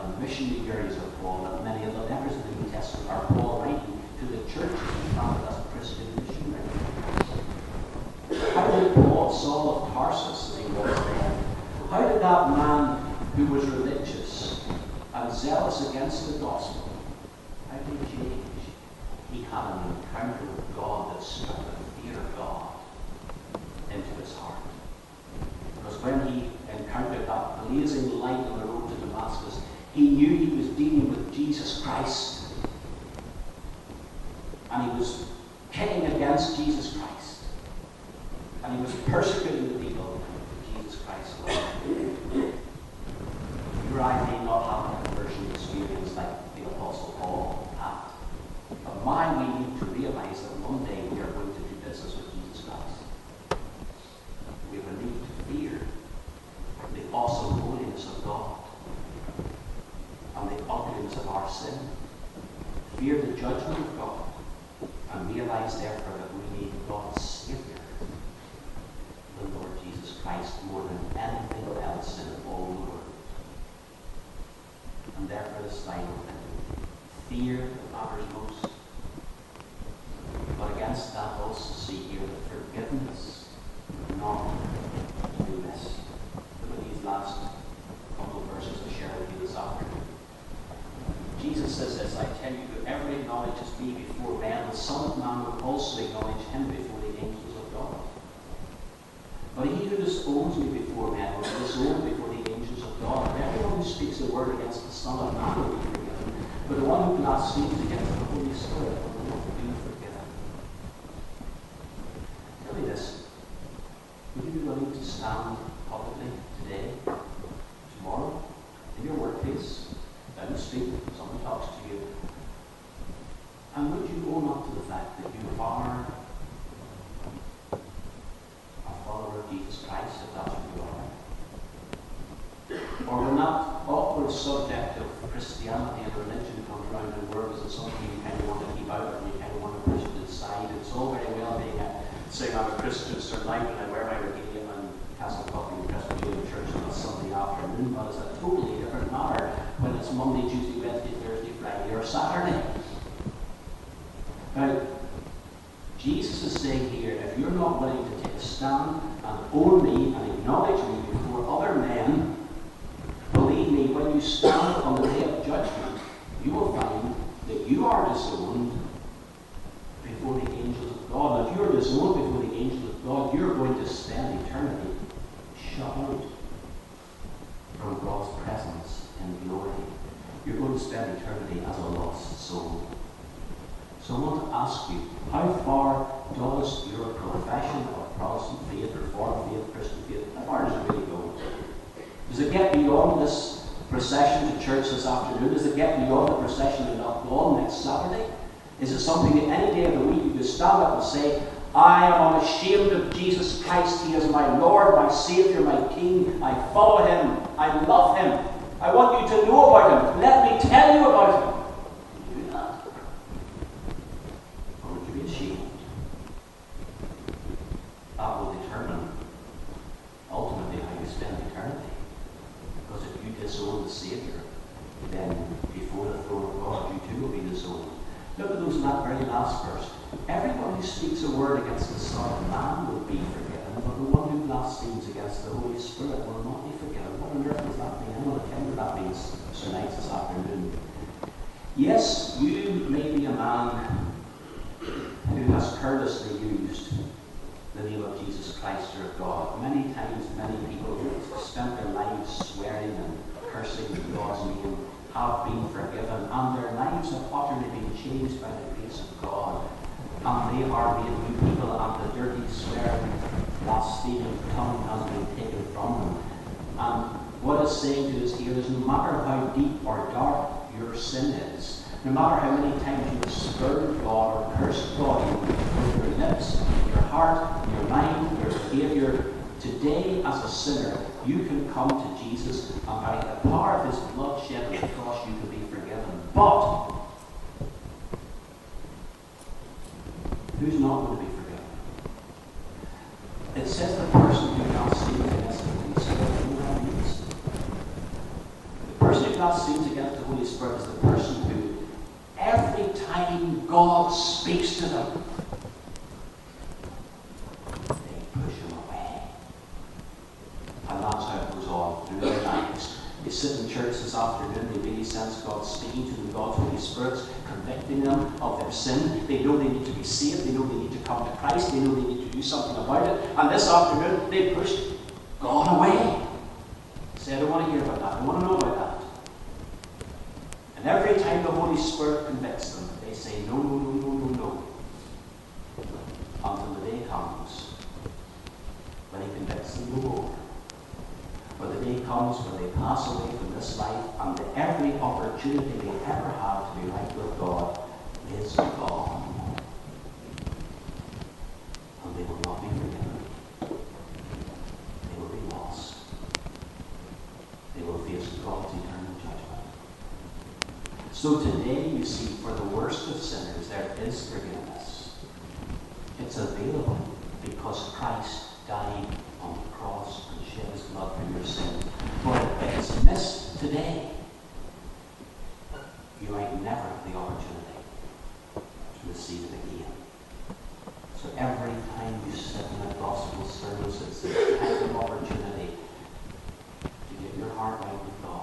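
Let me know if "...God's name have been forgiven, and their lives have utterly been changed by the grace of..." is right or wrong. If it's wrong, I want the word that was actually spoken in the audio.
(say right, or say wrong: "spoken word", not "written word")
right.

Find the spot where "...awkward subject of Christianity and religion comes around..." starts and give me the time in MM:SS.
02:13.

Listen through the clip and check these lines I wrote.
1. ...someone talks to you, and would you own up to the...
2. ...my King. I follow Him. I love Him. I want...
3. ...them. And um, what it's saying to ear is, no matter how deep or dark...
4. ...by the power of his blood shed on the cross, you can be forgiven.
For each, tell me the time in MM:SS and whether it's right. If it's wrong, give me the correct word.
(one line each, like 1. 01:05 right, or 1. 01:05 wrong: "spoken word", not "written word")
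1. 02:01 right
2. 03:25 right
3. 04:25 right
4. 04:42 right.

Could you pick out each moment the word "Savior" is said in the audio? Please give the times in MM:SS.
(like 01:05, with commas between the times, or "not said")
03:25, 03:43.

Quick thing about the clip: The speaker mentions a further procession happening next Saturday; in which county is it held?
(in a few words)
Donegal.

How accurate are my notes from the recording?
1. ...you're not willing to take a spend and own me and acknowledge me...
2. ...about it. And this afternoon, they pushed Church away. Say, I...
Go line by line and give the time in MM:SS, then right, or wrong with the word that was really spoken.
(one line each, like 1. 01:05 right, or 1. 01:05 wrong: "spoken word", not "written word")
1. 02:37 wrong: "stand", not "spend"
2. 05:22 wrong: "God", not "Church".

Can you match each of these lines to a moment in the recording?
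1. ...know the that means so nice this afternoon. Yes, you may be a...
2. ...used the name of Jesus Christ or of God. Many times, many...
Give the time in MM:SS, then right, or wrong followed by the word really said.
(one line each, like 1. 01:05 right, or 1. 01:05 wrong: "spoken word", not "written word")
1. 03:58 right
2. 04:06 right.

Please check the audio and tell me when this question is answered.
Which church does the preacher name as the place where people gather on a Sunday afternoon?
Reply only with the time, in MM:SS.
02:25.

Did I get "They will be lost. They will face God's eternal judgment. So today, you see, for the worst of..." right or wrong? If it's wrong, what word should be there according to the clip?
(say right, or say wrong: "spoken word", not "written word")
right.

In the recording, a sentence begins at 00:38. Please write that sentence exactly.
And he was persecuting the people.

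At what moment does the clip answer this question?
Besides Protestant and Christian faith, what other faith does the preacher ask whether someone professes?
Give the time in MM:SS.
03:08.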